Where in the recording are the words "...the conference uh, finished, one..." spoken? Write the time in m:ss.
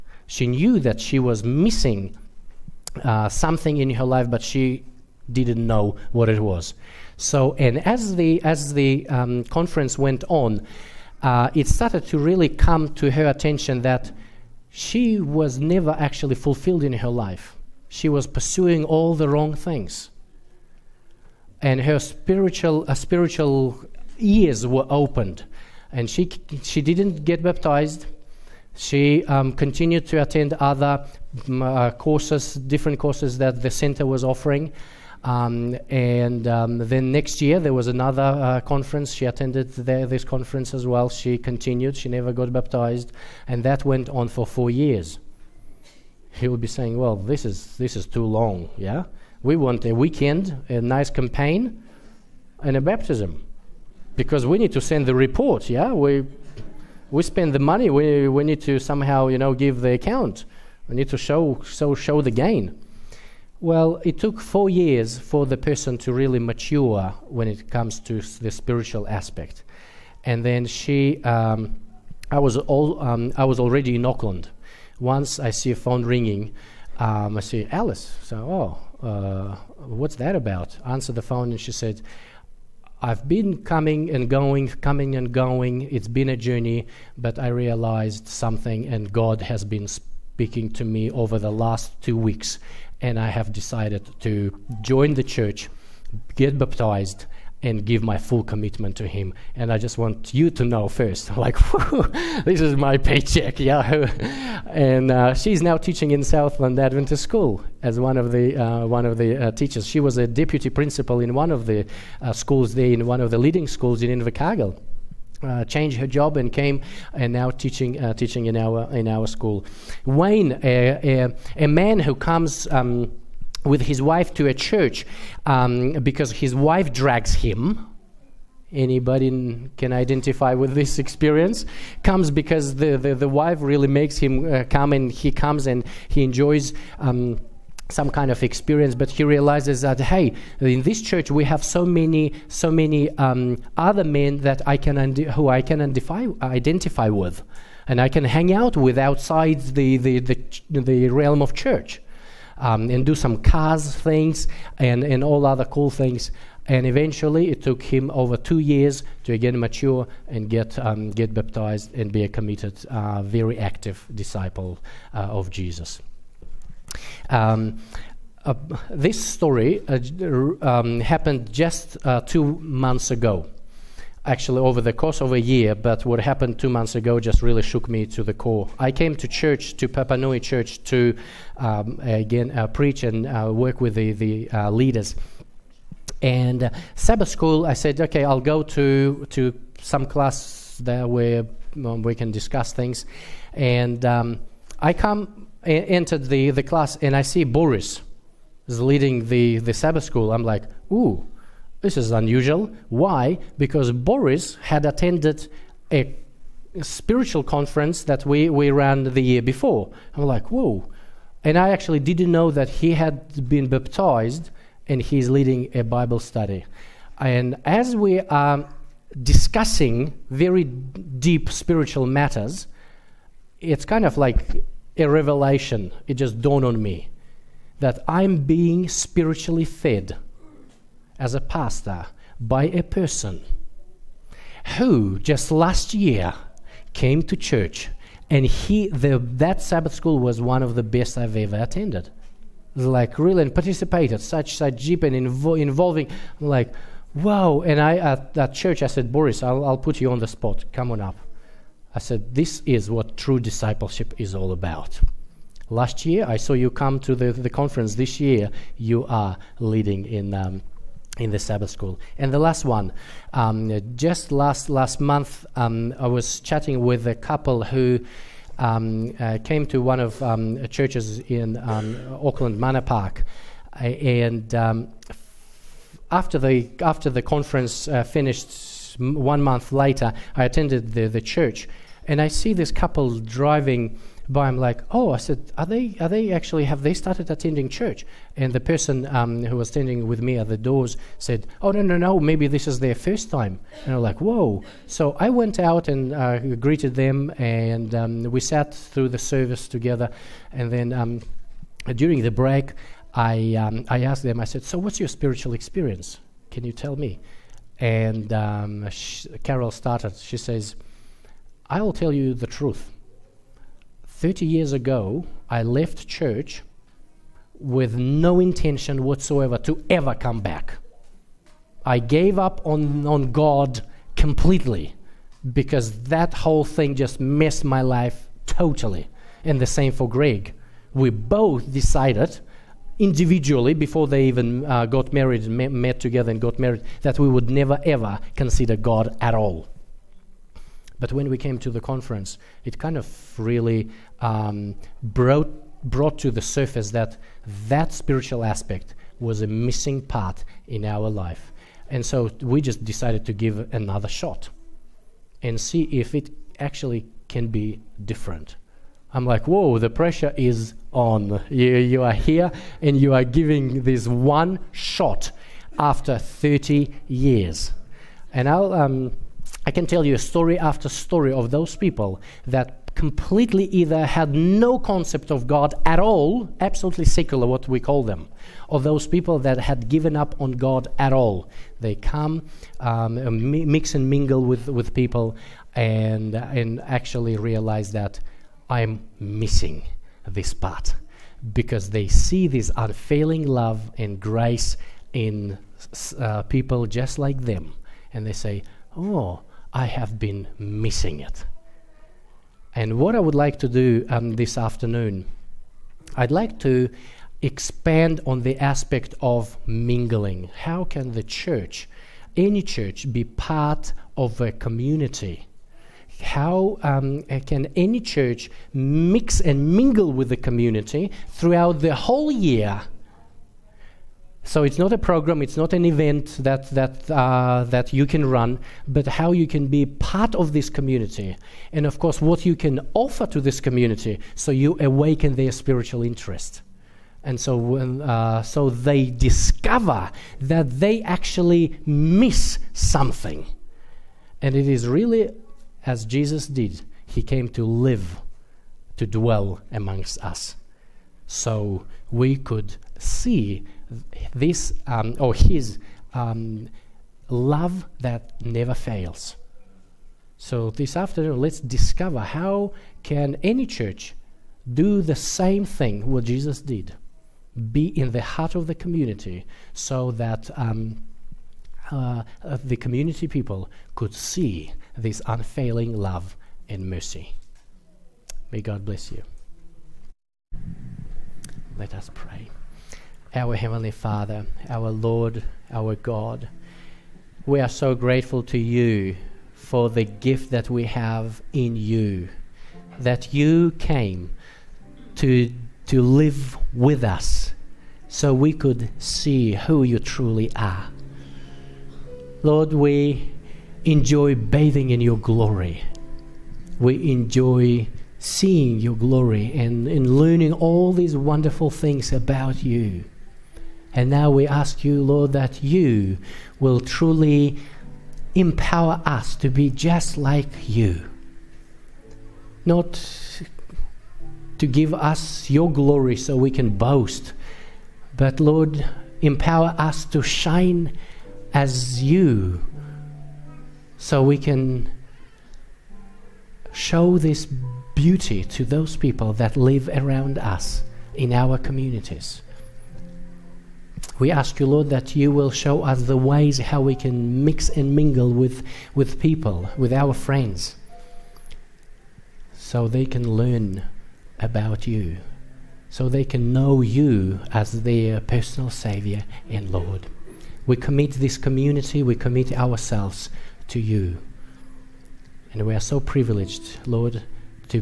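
4:37.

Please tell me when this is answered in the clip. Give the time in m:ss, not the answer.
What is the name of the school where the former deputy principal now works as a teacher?
1:46.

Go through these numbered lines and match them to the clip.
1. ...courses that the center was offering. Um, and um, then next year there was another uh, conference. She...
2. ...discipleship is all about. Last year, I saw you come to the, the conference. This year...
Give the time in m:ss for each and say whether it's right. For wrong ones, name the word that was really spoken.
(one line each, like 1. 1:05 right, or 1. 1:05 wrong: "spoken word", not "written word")
1. 0:32 right
2. 4:13 right.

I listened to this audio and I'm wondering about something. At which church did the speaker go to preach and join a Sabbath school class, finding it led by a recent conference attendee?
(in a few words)
Papanui Church.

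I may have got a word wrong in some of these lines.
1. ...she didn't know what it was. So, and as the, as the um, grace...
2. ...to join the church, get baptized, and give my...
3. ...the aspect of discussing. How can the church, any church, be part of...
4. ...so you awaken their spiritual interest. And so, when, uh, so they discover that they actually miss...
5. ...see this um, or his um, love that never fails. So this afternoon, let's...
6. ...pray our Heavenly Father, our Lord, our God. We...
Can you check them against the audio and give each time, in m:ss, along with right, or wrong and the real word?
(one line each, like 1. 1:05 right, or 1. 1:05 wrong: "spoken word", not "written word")
1. 0:04 wrong: "conference", not "grace"
2. 1:34 right
3. 6:48 wrong: "mingling", not "discussing"
4. 7:14 right
5. 7:32 right
6. 8:02 right.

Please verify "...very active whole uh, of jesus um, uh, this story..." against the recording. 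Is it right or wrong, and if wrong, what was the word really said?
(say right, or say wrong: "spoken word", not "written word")
wrong: "disciple", not "whole".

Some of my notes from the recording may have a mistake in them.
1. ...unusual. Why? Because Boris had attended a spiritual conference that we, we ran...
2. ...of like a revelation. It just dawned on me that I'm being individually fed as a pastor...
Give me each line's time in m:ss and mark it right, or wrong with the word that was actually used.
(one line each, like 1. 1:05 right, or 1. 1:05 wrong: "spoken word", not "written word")
1. 3:22 right
2. 3:44 wrong: "spiritually", not "individually".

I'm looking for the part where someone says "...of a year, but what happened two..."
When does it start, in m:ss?
2:55.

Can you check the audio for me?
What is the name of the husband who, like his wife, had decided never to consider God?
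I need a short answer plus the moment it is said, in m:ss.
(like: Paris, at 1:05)
Greg, at 5:30.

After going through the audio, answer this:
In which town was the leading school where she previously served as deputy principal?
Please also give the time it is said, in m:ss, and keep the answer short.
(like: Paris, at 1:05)
Invercargill, at 1:54.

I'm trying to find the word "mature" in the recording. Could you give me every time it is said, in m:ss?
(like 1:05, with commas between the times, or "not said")
1:06, 2:39.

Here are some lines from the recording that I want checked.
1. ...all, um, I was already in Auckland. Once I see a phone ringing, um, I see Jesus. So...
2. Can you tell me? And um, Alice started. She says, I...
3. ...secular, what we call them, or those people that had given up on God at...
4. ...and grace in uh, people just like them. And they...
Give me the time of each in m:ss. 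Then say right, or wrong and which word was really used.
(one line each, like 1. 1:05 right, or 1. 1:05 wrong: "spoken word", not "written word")
1. 1:12 wrong: "Alice", not "Jesus"
2. 5:06 wrong: "Carol", not "Alice"
3. 6:17 right
4. 6:33 right.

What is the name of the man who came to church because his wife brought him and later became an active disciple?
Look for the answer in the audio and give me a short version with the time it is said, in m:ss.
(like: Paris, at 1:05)
Wayne, at 2:00.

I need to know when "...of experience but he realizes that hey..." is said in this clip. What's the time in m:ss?
2:18.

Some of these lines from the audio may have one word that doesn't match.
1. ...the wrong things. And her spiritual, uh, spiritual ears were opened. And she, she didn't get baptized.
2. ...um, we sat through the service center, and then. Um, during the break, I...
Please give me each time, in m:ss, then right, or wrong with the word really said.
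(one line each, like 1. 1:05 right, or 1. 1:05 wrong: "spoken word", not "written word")
1. 0:19 right
2. 4:57 wrong: "together", not "center".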